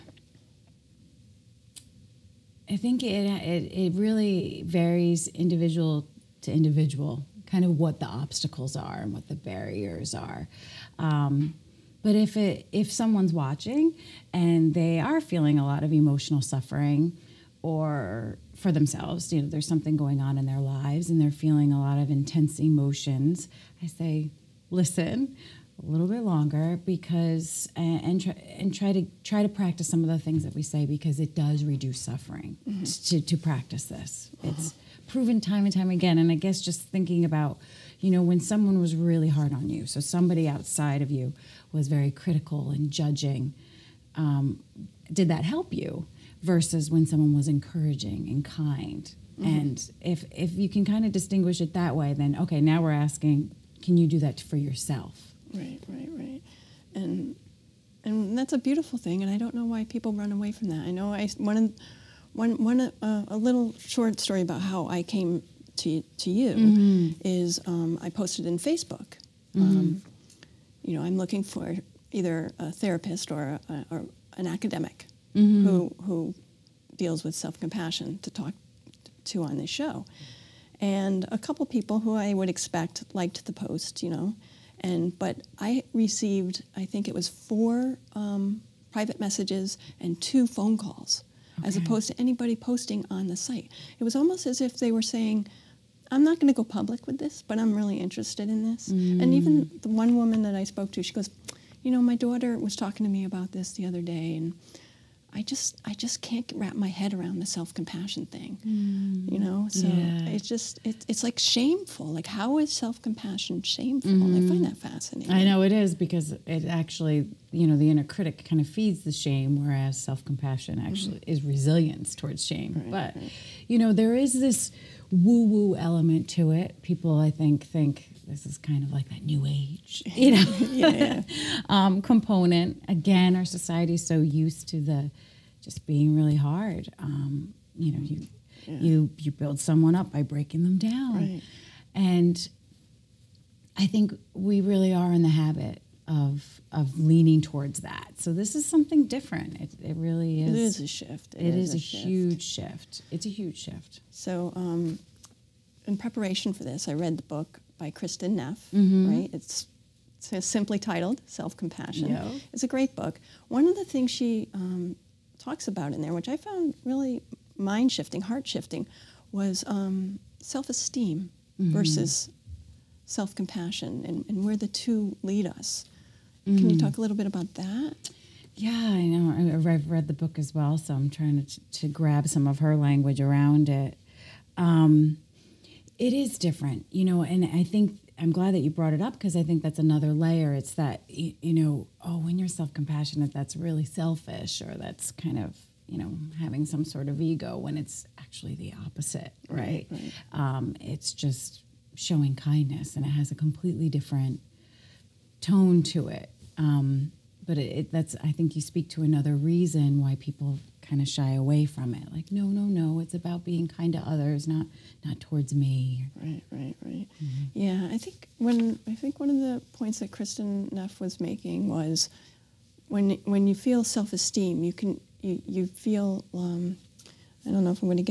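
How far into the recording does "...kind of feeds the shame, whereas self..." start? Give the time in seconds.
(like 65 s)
118 s.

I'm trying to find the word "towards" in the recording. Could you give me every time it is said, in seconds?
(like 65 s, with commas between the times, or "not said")
122 s, 147 s, 215 s.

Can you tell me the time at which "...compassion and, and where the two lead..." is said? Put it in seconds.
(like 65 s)
173 s.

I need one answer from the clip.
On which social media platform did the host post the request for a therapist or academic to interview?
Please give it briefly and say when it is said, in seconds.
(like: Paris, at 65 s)
Facebook, at 68 s.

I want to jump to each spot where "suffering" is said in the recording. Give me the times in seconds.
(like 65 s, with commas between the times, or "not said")
16 s, 31 s.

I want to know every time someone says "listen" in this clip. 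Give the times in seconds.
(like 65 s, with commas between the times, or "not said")
24 s.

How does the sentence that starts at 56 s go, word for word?
And and that's a beautiful thing.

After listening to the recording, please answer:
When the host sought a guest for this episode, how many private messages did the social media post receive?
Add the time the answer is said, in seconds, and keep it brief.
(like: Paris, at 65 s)
4, at 87 s.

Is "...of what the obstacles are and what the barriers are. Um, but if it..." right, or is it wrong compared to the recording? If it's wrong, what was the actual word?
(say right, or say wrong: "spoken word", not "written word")
right.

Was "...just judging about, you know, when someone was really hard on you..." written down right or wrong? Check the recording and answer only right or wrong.
wrong.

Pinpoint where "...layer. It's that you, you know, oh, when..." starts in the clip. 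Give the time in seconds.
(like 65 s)
190 s.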